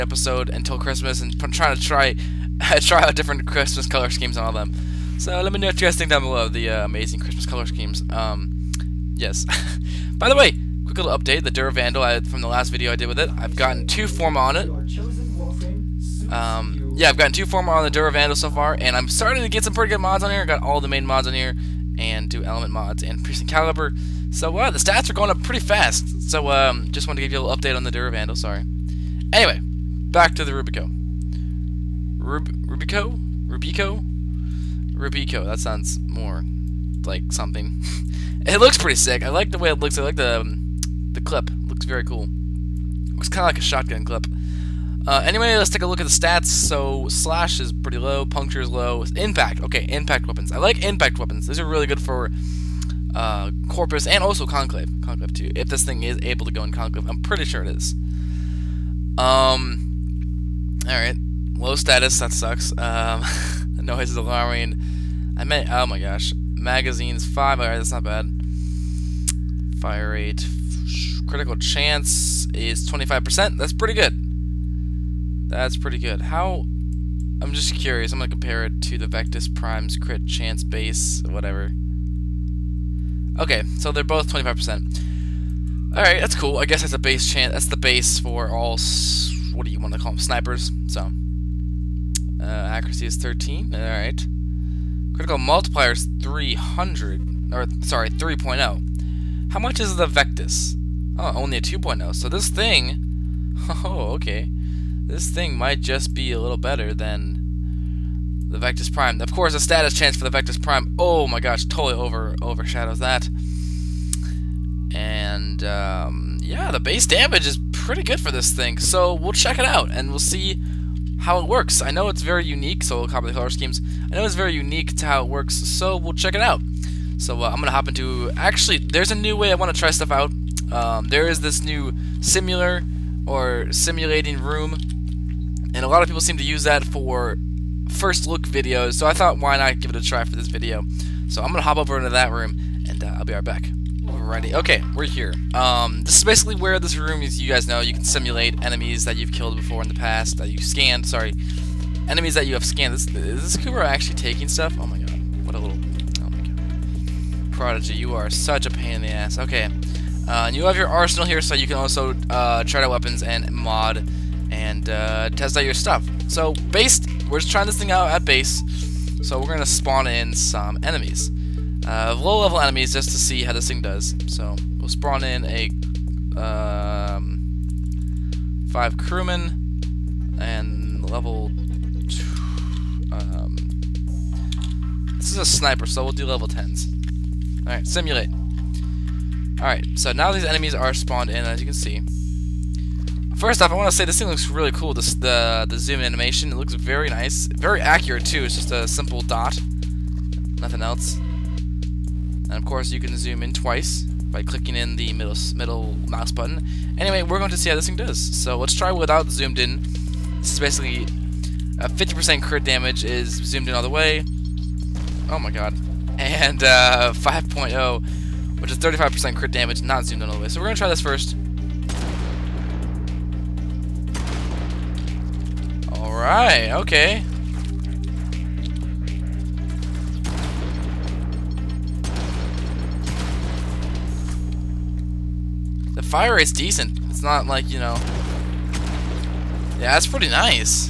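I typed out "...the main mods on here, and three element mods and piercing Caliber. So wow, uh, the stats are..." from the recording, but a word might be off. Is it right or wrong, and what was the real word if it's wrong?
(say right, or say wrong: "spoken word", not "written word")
wrong: "two", not "three".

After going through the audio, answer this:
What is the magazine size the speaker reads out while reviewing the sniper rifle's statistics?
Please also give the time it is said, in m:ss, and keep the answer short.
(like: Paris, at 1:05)
5, at 1:06.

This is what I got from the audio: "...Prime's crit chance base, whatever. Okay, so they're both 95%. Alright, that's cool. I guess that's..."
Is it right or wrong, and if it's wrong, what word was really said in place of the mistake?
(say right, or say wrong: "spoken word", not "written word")
wrong: "25", not "95".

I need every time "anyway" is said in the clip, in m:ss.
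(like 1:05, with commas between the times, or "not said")
0:29, 0:45, 3:26.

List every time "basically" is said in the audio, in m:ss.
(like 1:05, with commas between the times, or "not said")
2:26, 3:30.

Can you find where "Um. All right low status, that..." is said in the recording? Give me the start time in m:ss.
0:59.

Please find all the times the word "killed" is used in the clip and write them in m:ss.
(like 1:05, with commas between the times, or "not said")
2:29.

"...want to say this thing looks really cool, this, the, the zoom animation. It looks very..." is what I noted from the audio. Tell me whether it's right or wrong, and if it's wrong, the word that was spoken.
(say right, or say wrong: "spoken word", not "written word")
right.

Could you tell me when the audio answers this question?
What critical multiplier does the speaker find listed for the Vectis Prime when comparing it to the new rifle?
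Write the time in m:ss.
1:41.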